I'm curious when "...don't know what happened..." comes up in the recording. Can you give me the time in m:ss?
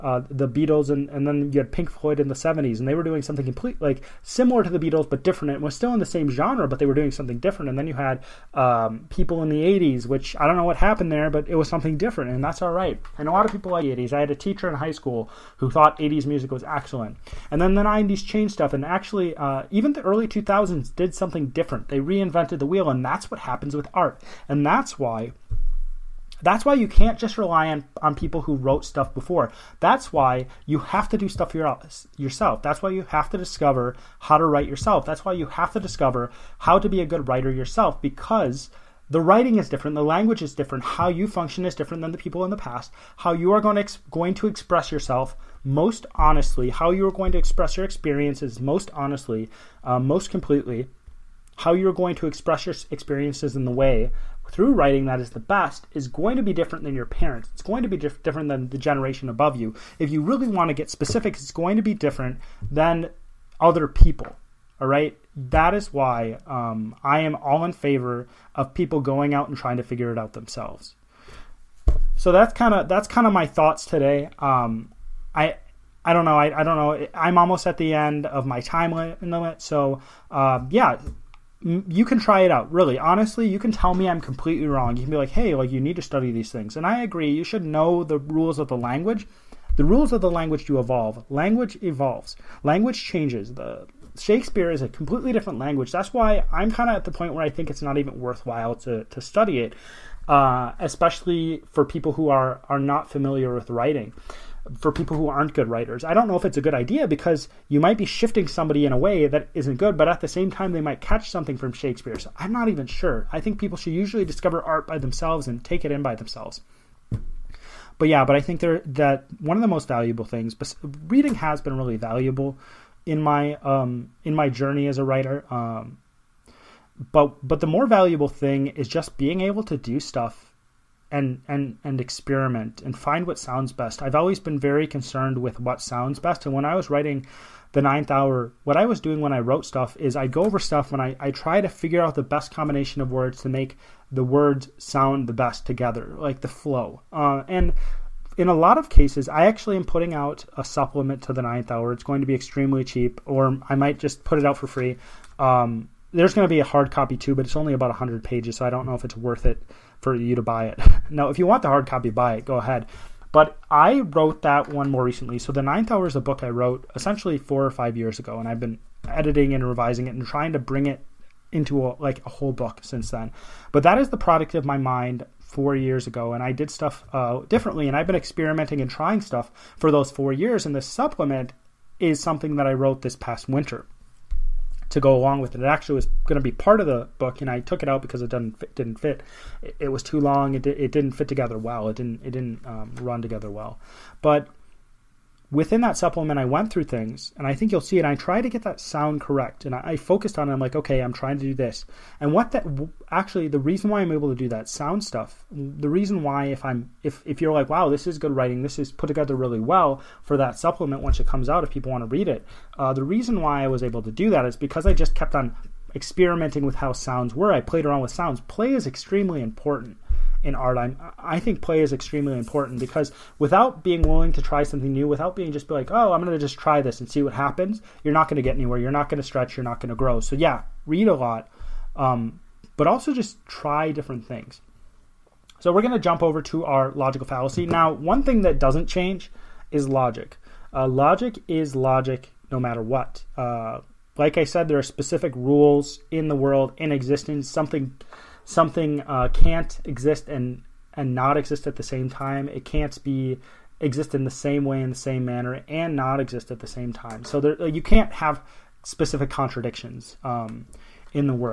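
0:10.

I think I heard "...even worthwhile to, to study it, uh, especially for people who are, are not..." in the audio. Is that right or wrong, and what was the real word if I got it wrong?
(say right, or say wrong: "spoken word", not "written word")
right.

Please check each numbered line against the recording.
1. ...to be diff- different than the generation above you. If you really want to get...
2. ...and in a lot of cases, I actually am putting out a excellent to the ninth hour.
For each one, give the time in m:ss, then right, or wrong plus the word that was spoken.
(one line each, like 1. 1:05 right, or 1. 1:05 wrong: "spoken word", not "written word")
1. 0:57 right
2. 2:27 wrong: "supplement", not "excellent".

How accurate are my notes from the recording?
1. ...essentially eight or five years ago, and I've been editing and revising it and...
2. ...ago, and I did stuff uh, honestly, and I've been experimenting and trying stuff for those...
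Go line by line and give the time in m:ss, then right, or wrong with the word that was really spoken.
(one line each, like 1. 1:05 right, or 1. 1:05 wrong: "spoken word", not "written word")
1. 2:46 wrong: "four", not "eight"
2. 2:56 wrong: "differently", not "honestly".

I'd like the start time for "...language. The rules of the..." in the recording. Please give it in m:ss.
1:28.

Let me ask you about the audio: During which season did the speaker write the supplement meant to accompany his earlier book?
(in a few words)
Winter.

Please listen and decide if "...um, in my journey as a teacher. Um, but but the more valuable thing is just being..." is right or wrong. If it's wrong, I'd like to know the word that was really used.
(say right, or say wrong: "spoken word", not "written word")
wrong: "writer", not "teacher".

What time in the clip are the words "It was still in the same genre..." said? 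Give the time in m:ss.
0:05.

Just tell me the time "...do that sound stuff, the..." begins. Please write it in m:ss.
3:24.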